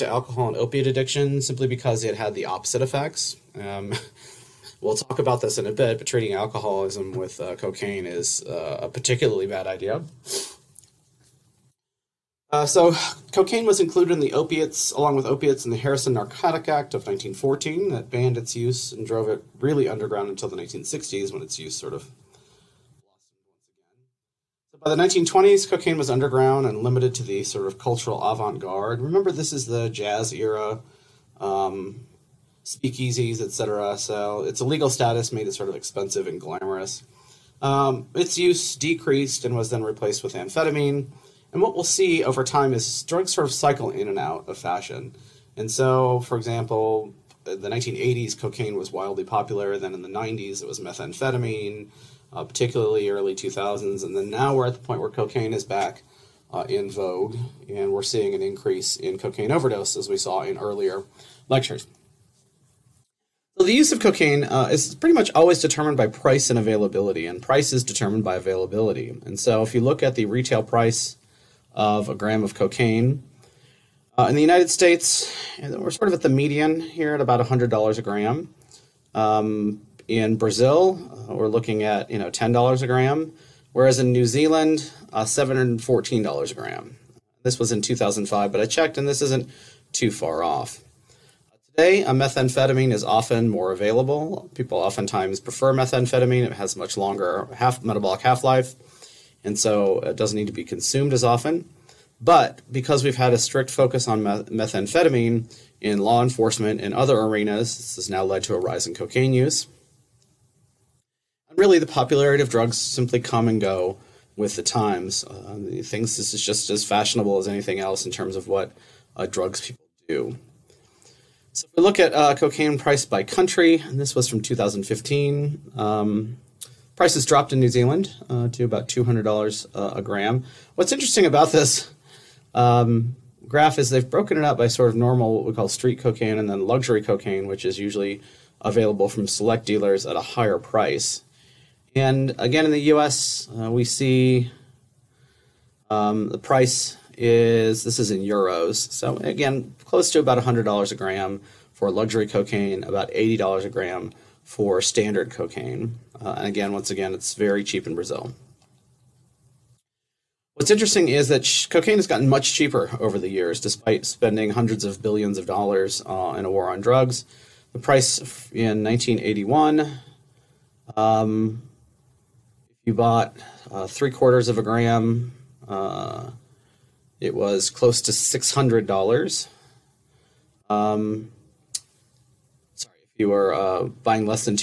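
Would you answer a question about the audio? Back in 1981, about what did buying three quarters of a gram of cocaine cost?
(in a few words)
$600.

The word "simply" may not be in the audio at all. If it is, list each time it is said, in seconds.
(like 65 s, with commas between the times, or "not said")
1 s, 112 s.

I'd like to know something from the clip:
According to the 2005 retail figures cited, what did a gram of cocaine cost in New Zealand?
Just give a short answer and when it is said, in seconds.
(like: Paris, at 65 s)
$714, at 85 s.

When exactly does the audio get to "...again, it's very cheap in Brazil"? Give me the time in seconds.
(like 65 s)
156 s.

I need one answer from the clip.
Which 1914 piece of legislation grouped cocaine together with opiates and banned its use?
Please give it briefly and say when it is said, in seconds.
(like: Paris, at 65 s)
Harrison Narcotic Act, at 15 s.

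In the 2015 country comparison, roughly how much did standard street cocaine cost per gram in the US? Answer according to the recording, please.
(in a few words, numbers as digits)
$80.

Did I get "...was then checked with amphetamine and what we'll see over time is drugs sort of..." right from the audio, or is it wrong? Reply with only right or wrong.
wrong.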